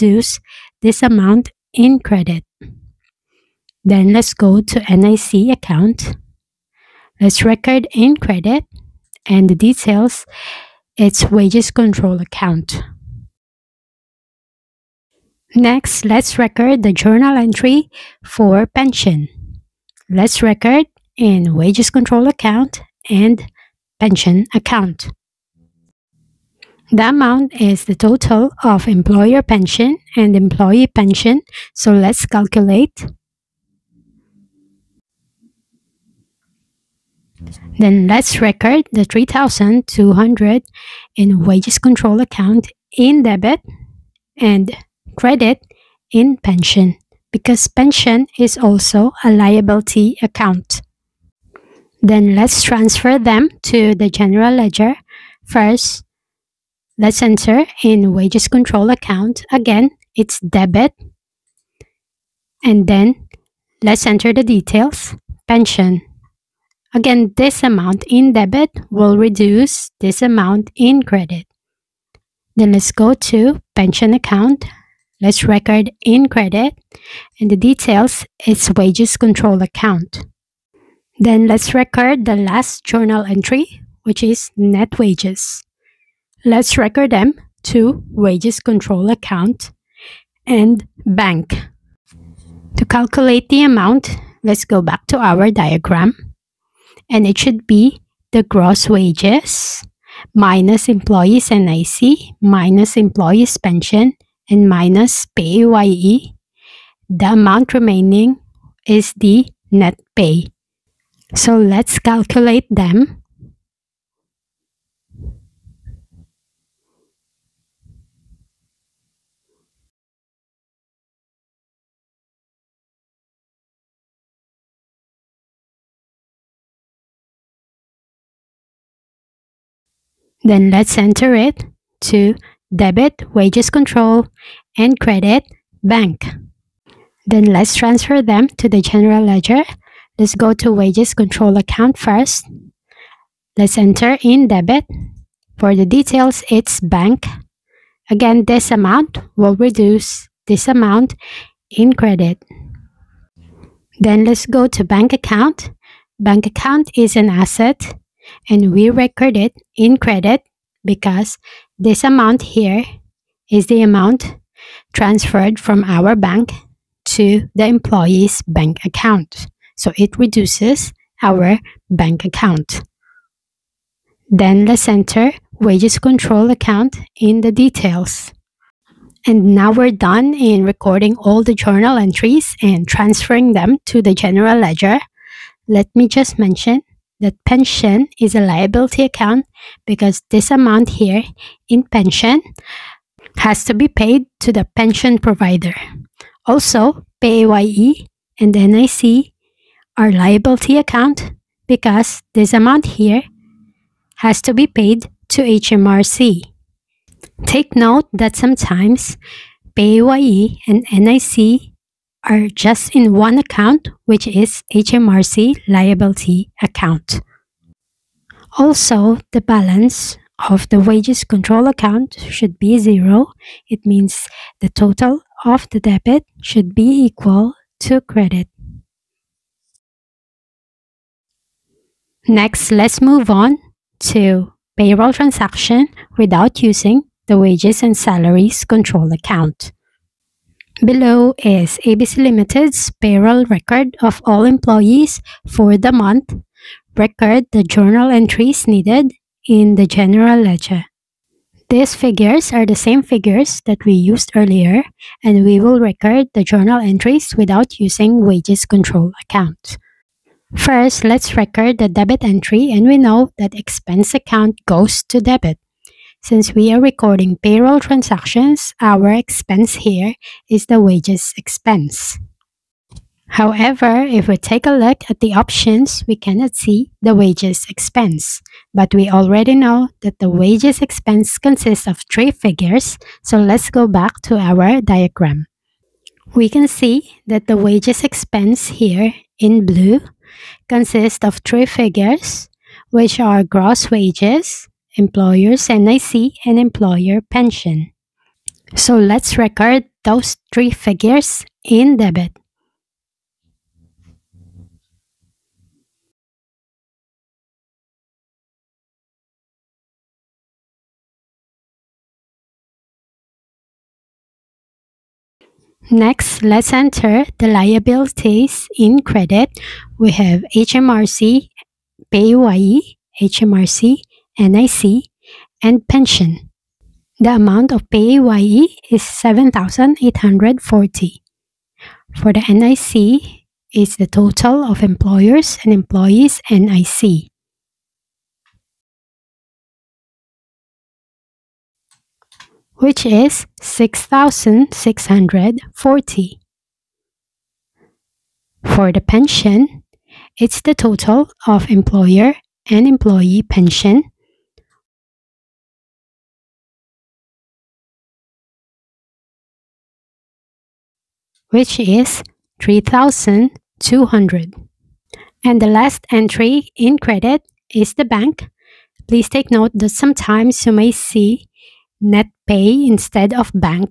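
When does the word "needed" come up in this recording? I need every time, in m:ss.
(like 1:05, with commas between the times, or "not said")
4:08.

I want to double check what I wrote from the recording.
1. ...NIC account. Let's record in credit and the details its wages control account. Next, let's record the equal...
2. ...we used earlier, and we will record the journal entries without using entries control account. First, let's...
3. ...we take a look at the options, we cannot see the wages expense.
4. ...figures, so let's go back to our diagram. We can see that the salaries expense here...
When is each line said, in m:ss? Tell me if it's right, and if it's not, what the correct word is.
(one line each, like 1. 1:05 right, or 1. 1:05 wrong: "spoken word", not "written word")
1. 0:04 wrong: "journal", not "equal"
2. 4:13 wrong: "wages", not "entries"
3. 4:34 right
4. 4:42 wrong: "wages", not "salaries".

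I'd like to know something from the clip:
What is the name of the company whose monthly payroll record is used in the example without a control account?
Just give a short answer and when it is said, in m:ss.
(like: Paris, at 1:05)
ABC Limited, at 4:01.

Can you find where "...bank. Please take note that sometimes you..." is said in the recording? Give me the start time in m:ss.
6:08.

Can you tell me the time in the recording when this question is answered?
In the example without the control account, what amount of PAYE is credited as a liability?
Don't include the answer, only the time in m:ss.
5:29.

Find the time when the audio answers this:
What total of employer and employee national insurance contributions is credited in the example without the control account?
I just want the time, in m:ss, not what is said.
5:43.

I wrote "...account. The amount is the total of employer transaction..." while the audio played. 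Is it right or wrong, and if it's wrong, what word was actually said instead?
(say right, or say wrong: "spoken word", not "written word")
wrong: "pension", not "transaction".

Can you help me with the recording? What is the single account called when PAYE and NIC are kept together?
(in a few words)
HMRC liability account.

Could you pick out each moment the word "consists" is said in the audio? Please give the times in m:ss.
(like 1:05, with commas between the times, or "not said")
4:41, 4:50.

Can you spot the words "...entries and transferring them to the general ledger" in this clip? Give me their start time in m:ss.
3:01.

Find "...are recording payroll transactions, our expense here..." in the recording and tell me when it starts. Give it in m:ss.
4:26.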